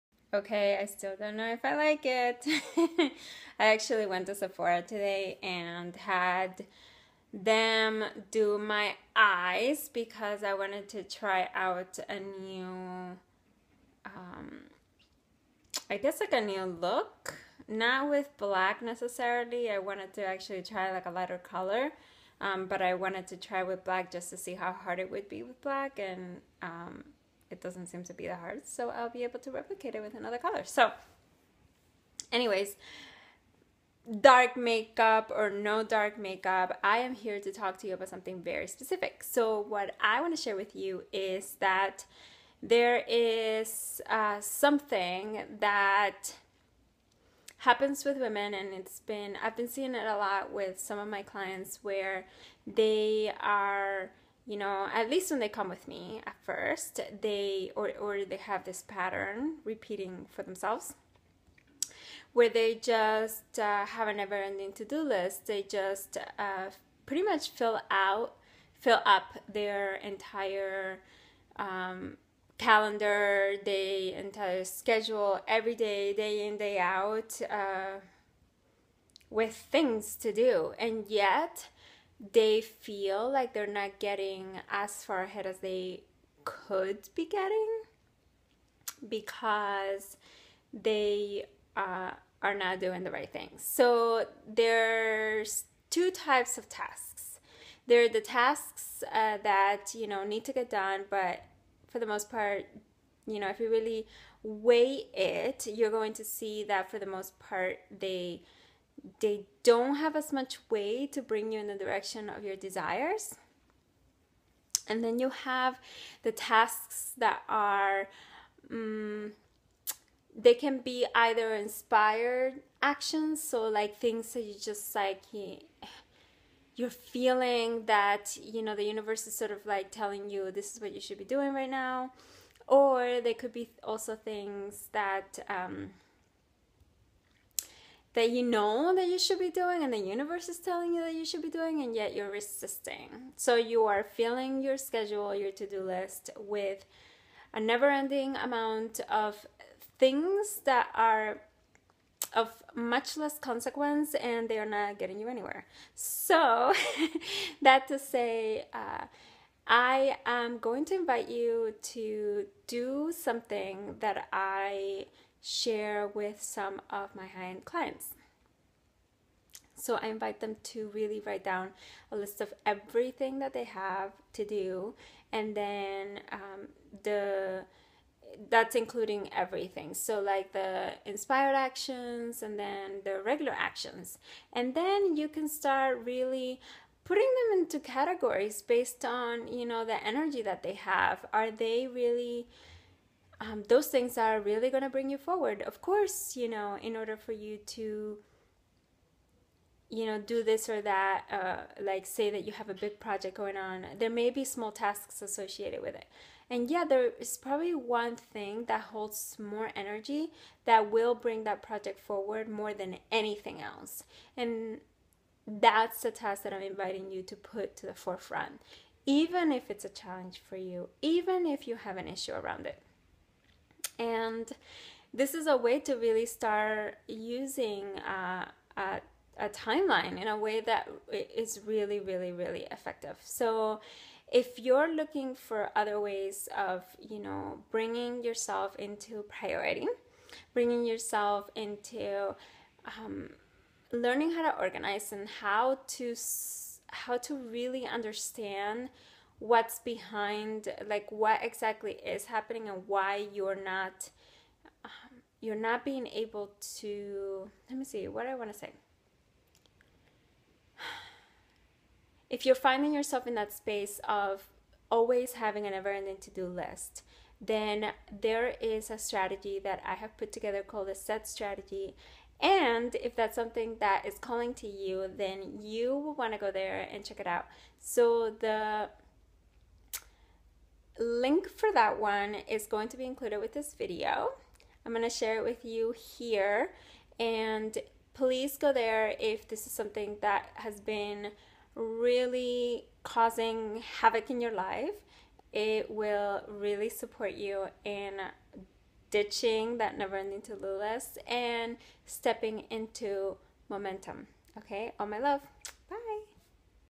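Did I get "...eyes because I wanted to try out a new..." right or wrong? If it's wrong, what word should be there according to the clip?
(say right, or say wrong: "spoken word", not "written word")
right.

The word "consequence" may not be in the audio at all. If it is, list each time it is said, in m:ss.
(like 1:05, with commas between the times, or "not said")
2:33.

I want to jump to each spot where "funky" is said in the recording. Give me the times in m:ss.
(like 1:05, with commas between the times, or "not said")
not said.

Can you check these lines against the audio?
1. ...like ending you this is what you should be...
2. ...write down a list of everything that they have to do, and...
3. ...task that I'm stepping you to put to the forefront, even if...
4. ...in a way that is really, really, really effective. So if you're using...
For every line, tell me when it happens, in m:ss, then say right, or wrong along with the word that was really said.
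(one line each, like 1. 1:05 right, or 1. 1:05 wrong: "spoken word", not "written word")
1. 2:09 wrong: "telling", not "ending"
2. 2:51 right
3. 3:36 wrong: "inviting", not "stepping"
4. 3:50 wrong: "looking", not "using".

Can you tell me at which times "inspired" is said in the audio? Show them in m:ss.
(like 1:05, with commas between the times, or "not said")
2:01, 3:01.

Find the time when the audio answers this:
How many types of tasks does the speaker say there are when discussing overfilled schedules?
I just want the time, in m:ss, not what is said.
1:35.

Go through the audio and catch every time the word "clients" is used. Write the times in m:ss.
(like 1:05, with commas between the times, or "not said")
0:51, 2:47.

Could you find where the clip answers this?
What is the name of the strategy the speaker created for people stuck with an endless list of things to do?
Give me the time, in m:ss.
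4:30.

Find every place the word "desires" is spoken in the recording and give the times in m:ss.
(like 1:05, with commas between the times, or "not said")
1:52.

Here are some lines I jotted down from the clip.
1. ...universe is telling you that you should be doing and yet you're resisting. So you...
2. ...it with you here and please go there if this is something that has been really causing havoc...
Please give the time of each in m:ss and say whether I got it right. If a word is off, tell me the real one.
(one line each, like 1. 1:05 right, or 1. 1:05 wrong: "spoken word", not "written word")
1. 2:19 right
2. 4:45 right.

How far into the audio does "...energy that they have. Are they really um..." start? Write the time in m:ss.
3:10.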